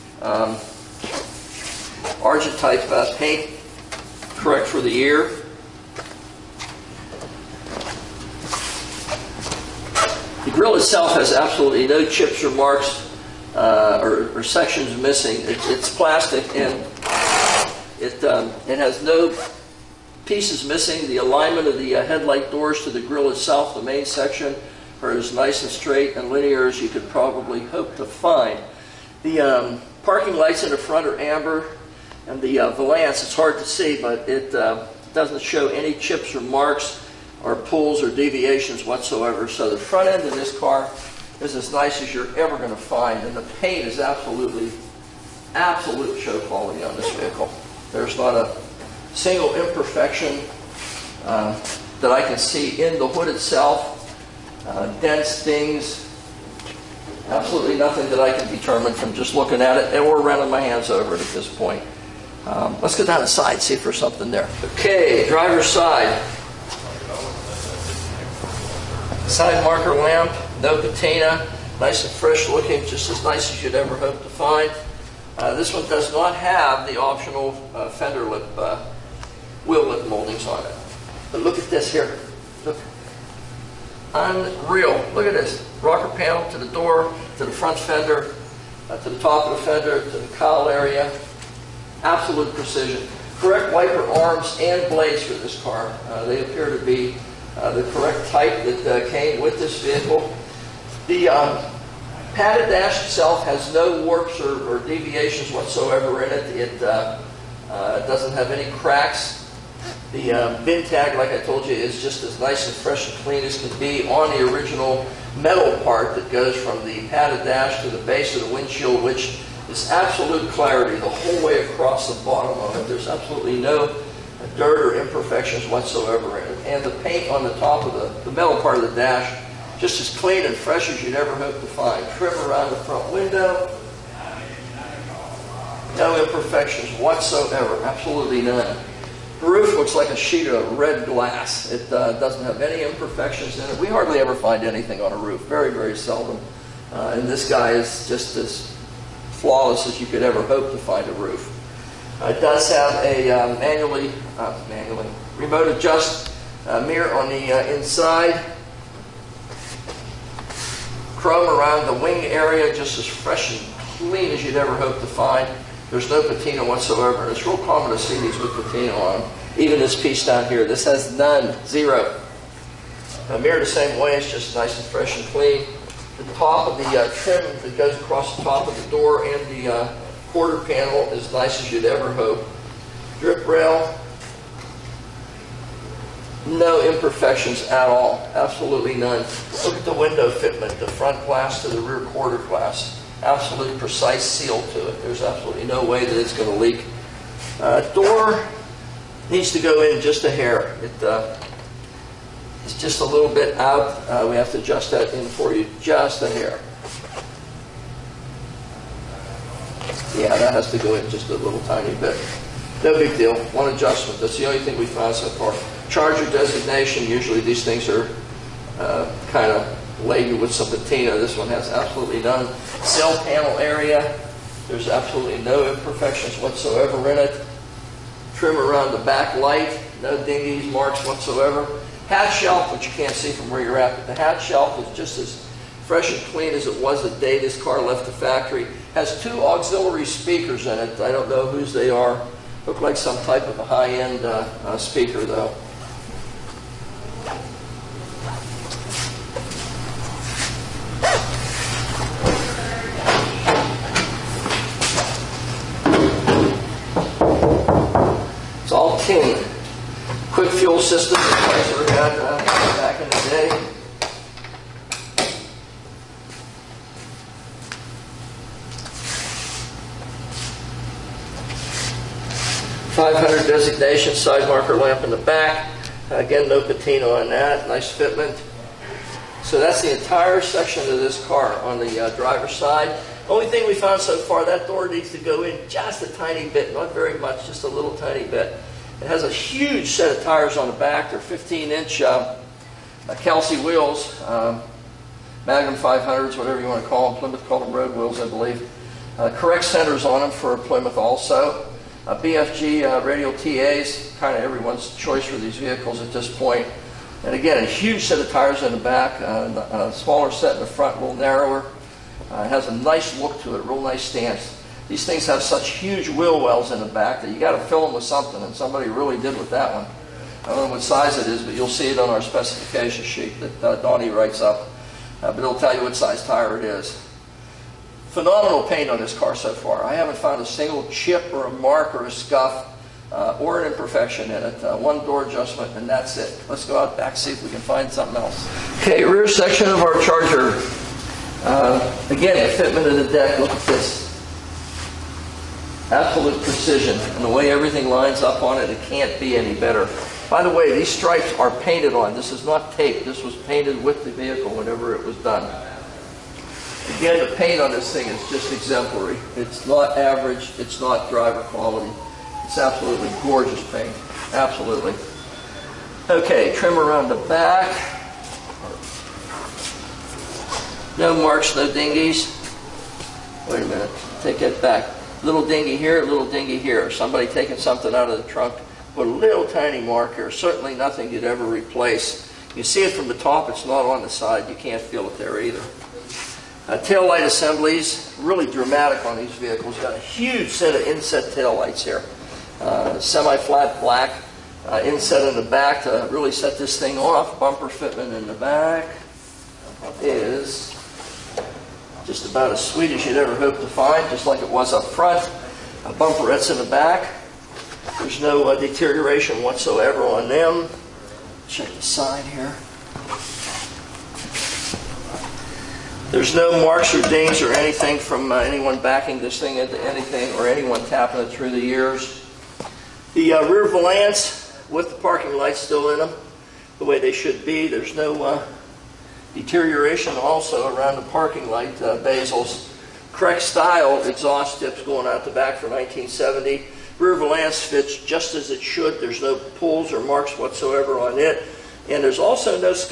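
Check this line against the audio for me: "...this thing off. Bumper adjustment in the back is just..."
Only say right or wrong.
wrong.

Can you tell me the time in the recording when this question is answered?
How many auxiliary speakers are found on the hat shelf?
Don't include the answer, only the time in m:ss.
3:59.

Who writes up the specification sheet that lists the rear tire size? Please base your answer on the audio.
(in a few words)
Donnie.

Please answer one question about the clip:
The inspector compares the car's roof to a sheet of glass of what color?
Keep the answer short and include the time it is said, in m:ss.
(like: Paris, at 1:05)
Red, at 2:20.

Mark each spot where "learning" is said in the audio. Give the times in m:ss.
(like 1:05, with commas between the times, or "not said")
not said.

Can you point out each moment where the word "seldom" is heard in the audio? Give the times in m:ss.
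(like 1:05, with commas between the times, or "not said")
2:25.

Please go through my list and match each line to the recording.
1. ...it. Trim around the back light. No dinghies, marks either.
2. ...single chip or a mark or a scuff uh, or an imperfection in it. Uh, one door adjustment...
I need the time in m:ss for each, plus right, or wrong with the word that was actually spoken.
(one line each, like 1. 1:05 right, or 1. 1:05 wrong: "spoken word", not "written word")
1. 3:47 wrong: "whatsoever", not "either"
2. 5:30 right.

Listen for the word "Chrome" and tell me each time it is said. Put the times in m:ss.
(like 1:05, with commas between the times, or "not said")
2:41.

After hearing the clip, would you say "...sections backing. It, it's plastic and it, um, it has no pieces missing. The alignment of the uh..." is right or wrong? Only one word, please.
wrong.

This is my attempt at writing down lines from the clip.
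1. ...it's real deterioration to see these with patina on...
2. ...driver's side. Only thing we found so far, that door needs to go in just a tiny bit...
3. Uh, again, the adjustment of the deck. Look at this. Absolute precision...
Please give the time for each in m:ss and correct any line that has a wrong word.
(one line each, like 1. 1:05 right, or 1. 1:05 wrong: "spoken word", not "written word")
1. 2:47 wrong: "common", not "deterioration"
2. 4:42 right
3. 5:41 wrong: "fitment", not "adjustment".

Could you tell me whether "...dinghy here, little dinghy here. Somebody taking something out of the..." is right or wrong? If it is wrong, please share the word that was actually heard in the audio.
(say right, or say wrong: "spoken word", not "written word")
right.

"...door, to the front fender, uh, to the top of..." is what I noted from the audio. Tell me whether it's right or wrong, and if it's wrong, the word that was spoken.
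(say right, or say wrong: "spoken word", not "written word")
right.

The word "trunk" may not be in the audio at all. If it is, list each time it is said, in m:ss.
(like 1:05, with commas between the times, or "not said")
6:18.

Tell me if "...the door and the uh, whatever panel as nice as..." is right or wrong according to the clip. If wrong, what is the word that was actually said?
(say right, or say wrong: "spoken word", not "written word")
wrong: "quarter", not "whatever".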